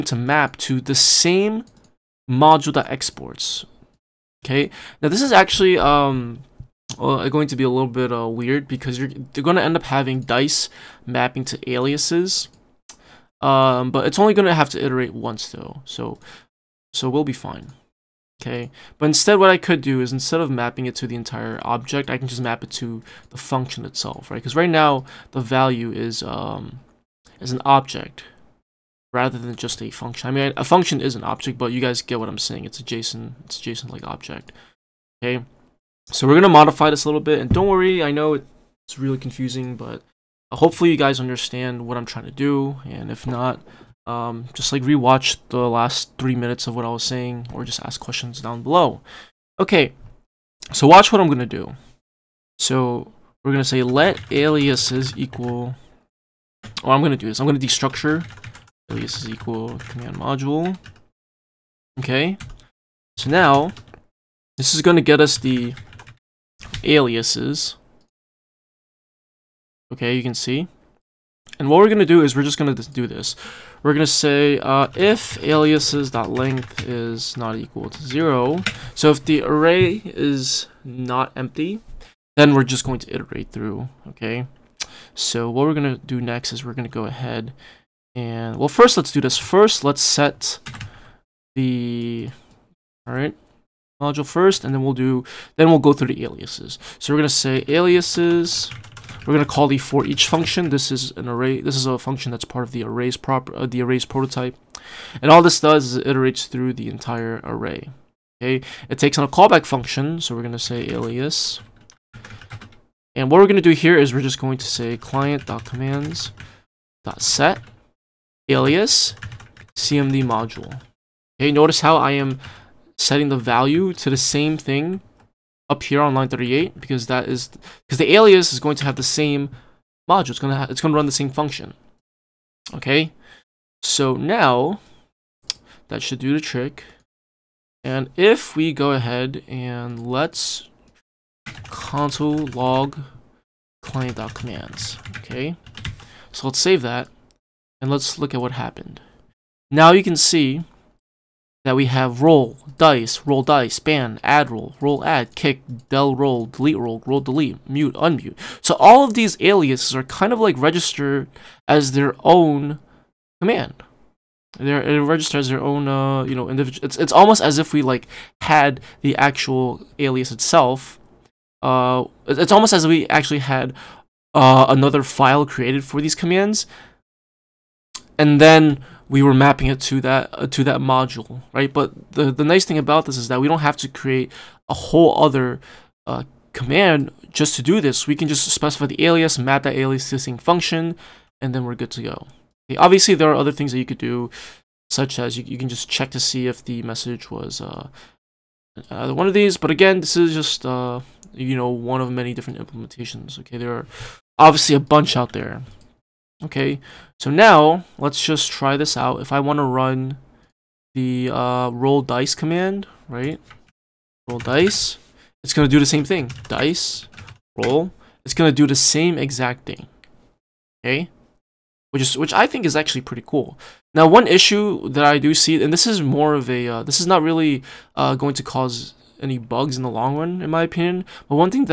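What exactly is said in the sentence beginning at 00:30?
I mean, a function is an object, but you guys get what I'm saying.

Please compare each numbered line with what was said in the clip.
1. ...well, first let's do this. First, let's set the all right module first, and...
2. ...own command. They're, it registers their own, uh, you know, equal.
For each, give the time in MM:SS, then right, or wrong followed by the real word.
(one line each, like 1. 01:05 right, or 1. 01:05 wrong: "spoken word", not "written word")
1. 01:28 right
2. 02:42 wrong: "individual", not "equal".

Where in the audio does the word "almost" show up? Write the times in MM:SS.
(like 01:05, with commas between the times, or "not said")
02:47, 02:52.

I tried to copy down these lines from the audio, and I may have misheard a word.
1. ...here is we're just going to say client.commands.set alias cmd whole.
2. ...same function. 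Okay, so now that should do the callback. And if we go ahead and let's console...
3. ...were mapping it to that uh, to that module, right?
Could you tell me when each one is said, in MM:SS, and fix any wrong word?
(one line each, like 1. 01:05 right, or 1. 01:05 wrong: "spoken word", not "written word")
1. 01:53 wrong: "module", not "whole"
2. 02:11 wrong: "trick", not "callback"
3. 02:59 right.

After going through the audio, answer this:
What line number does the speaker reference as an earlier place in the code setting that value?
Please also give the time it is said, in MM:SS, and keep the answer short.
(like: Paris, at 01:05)
38, at 02:06.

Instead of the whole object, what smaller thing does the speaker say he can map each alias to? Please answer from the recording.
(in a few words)
the function itself.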